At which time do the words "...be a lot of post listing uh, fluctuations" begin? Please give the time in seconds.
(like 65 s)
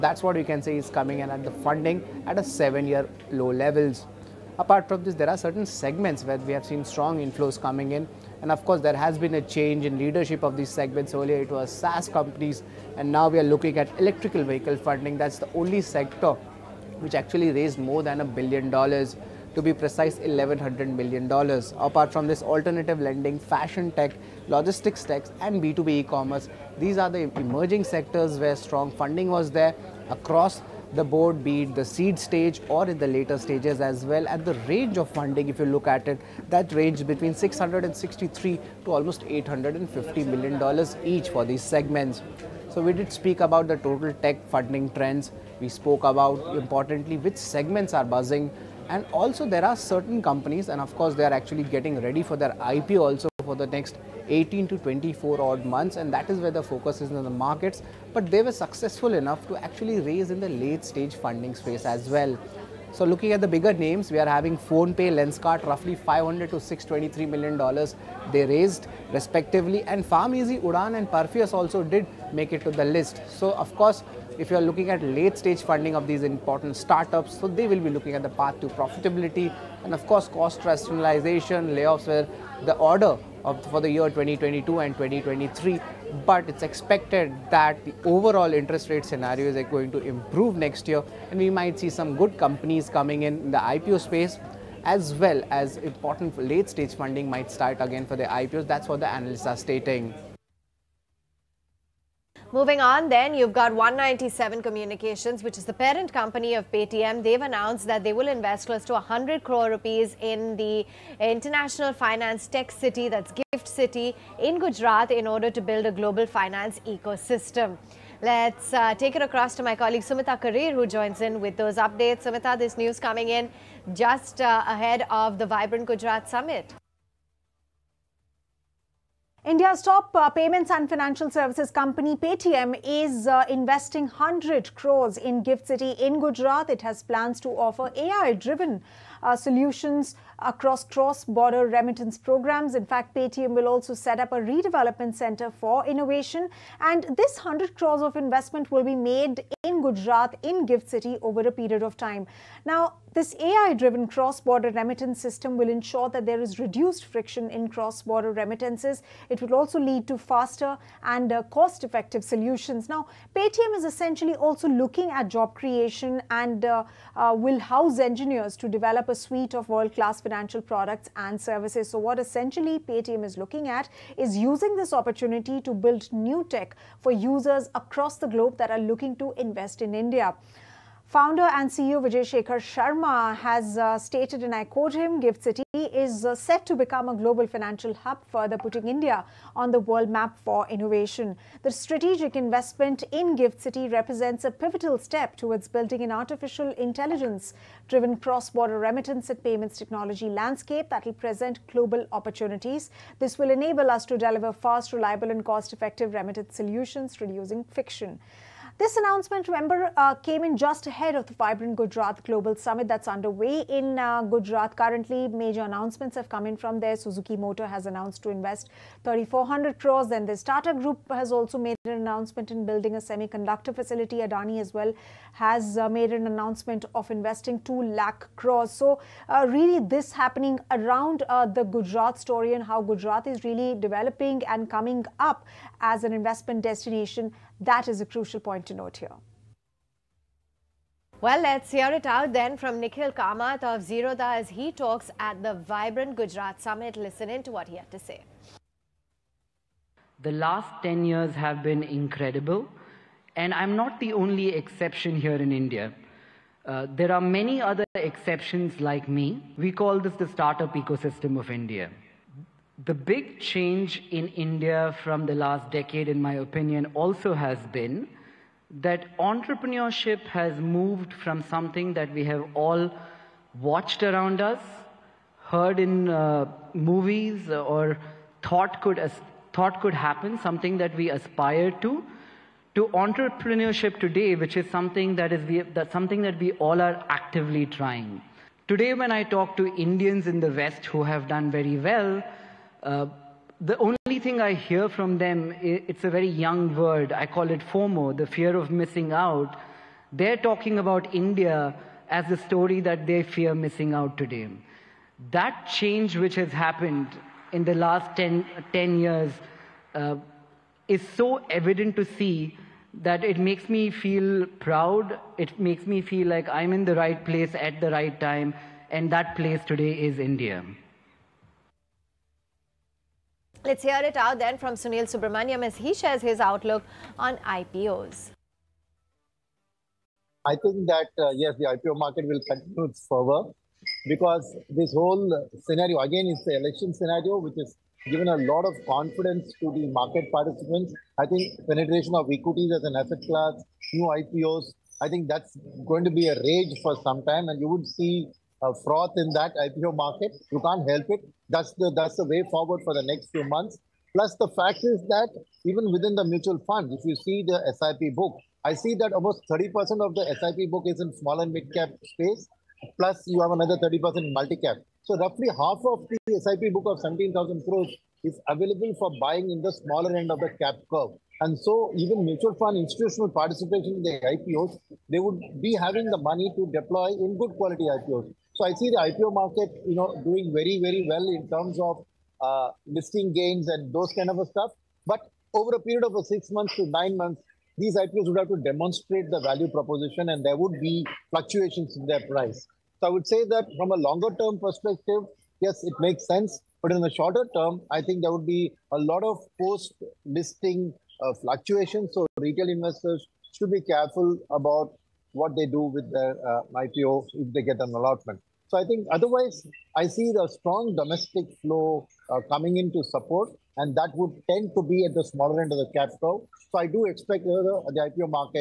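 398 s.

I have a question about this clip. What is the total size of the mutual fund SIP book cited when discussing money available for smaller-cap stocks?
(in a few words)
17,000 crores.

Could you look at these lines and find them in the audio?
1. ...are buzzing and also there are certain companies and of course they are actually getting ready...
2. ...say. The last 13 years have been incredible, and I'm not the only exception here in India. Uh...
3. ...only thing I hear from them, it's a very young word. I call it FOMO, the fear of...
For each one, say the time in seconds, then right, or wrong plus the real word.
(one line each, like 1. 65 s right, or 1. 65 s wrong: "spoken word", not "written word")
1. 47 s right
2. 247 s wrong: "10", not "13"
3. 293 s right.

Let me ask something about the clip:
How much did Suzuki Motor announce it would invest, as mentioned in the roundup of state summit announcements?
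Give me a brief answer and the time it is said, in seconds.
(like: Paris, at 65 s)
3,400 crores, at 219 s.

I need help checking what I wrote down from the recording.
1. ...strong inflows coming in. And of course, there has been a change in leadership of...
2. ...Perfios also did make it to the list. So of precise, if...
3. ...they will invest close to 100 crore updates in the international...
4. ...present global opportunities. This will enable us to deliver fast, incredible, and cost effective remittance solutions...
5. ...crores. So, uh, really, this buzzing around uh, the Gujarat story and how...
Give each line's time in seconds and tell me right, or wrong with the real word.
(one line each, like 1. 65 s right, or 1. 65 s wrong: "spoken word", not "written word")
1. 6 s right
2. 71 s wrong: "course", not "precise"
3. 108 s wrong: "rupees", not "updates"
4. 201 s wrong: "reliable", not "incredible"
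5. 228 s wrong: "happening", not "buzzing".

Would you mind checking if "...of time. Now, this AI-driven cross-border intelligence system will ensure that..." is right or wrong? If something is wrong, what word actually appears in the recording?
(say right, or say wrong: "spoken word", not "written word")
wrong: "remittance", not "intelligence".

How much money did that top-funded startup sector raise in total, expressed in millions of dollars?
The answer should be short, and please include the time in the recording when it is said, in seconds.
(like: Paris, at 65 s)
$1100 million, at 20 s.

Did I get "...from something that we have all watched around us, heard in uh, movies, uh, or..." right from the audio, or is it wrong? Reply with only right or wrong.
right.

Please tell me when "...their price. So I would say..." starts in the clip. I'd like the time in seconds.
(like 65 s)
392 s.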